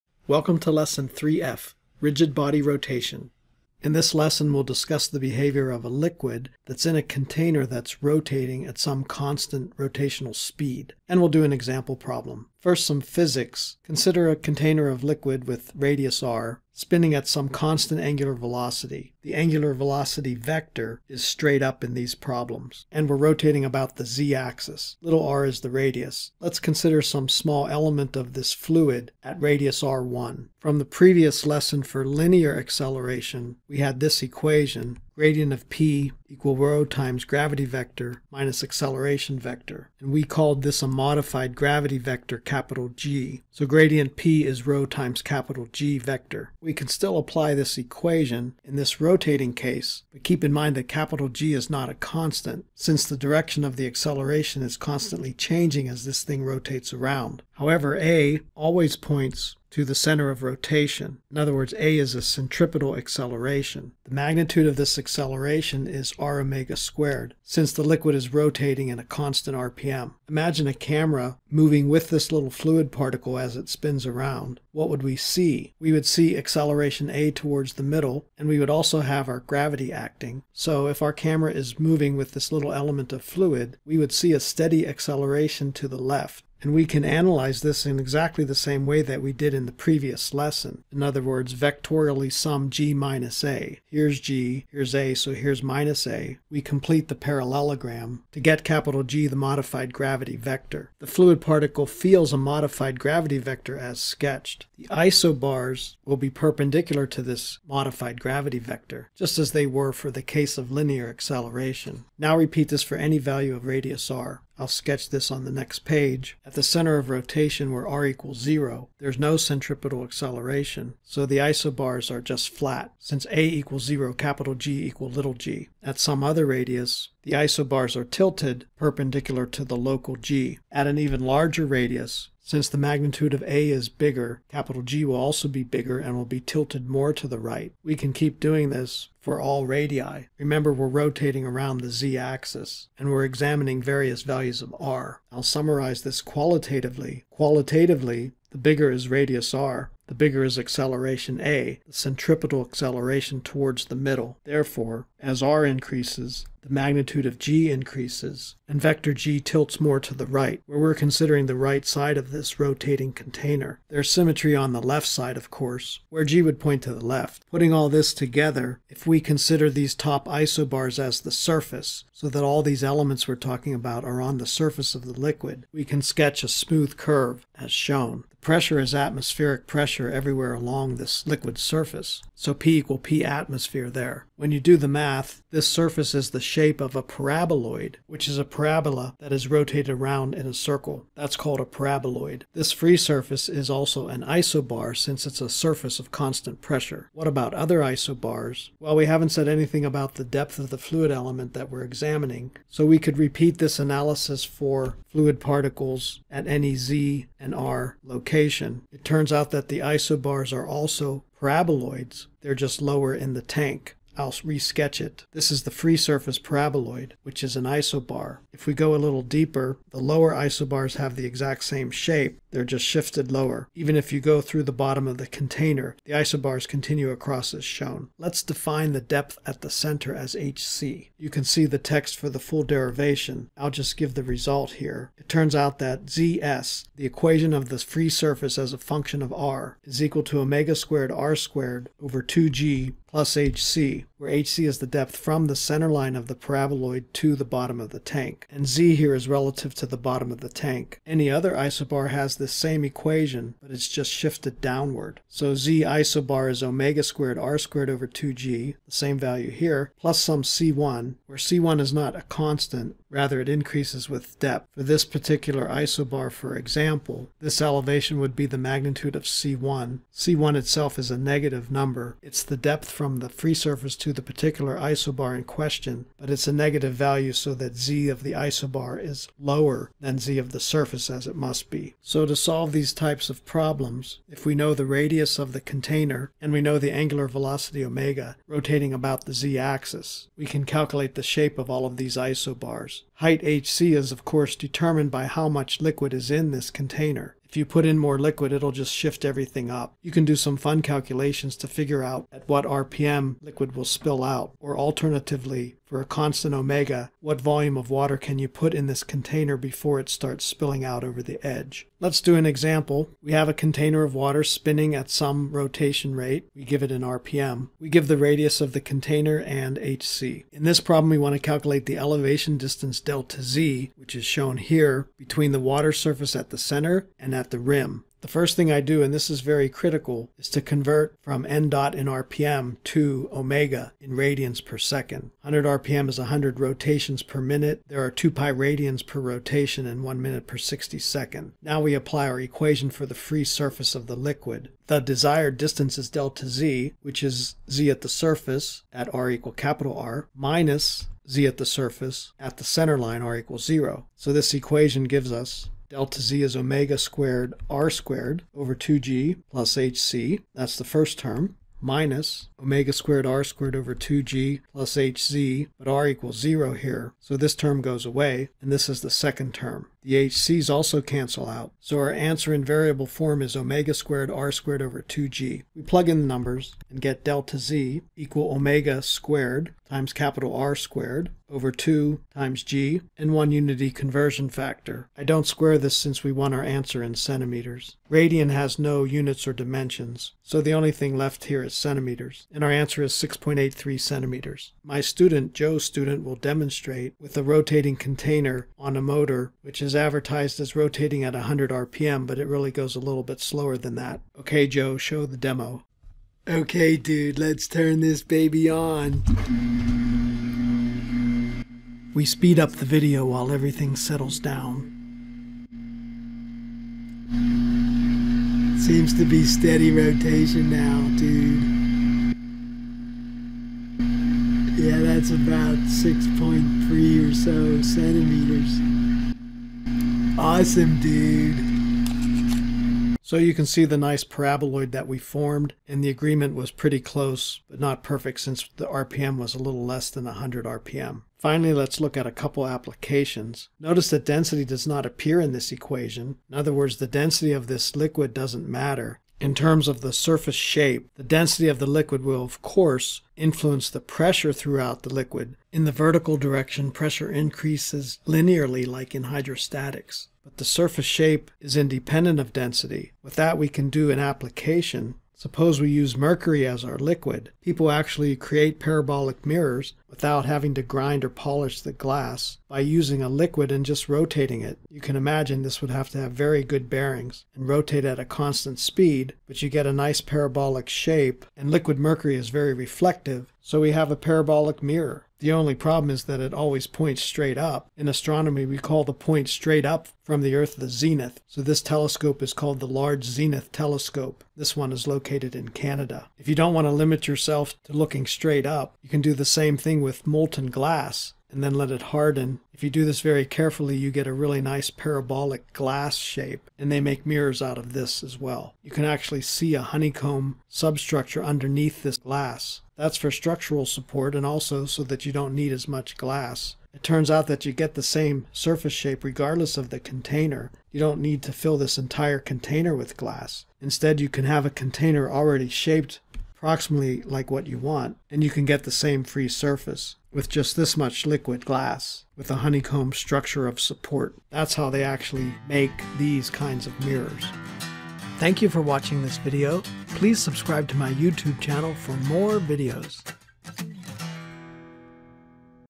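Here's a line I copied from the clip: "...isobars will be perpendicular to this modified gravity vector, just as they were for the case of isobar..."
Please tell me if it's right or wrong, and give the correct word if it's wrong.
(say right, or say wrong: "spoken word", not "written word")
wrong: "linear", not "isobar".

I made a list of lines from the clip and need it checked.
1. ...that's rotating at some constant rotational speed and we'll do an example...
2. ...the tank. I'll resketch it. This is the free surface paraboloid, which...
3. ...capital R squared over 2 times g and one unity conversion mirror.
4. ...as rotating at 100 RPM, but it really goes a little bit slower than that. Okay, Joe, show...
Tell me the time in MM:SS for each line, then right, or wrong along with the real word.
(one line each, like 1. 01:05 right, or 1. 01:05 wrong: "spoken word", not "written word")
1. 00:07 right
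2. 03:33 right
3. 06:20 wrong: "factor", not "mirror"
4. 06:40 right.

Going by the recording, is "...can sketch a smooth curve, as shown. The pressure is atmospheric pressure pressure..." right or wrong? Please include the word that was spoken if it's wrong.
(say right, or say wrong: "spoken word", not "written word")
right.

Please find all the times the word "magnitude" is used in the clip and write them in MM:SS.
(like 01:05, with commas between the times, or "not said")
01:04, 02:12, 02:36, 04:28.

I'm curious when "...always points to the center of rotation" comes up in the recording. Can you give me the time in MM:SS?
00:58.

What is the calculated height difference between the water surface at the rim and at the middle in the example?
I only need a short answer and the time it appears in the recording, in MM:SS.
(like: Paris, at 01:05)
6.83 centimeters, at 06:33.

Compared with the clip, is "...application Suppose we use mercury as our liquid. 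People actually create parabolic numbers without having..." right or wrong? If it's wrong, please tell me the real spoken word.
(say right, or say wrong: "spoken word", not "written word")
wrong: "mirrors", not "numbers".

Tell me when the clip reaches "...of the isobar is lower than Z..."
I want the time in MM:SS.
04:38.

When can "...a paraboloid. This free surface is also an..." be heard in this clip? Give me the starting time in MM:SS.
03:11.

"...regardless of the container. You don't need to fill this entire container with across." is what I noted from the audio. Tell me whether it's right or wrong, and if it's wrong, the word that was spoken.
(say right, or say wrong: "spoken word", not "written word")
wrong: "glass", not "across".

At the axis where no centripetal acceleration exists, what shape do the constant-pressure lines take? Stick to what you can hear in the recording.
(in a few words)
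Flat.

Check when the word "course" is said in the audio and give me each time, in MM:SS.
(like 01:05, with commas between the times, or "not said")
02:45, 04:54, 07:32.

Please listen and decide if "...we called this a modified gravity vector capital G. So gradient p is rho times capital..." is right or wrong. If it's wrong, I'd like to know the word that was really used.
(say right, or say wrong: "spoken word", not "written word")
right.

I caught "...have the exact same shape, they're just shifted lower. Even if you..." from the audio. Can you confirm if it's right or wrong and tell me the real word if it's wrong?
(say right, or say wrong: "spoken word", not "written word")
right.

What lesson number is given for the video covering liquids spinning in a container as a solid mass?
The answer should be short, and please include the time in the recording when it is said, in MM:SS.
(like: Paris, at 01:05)
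3F, at 00:00.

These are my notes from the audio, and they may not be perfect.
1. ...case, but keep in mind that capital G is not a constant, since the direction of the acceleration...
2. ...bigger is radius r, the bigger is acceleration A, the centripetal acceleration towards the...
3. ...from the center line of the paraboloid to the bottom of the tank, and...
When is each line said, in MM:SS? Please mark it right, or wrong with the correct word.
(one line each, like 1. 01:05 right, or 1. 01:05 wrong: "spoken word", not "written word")
1. 00:49 right
2. 02:28 right
3. 04:05 right.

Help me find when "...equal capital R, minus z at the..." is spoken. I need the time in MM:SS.
05:49.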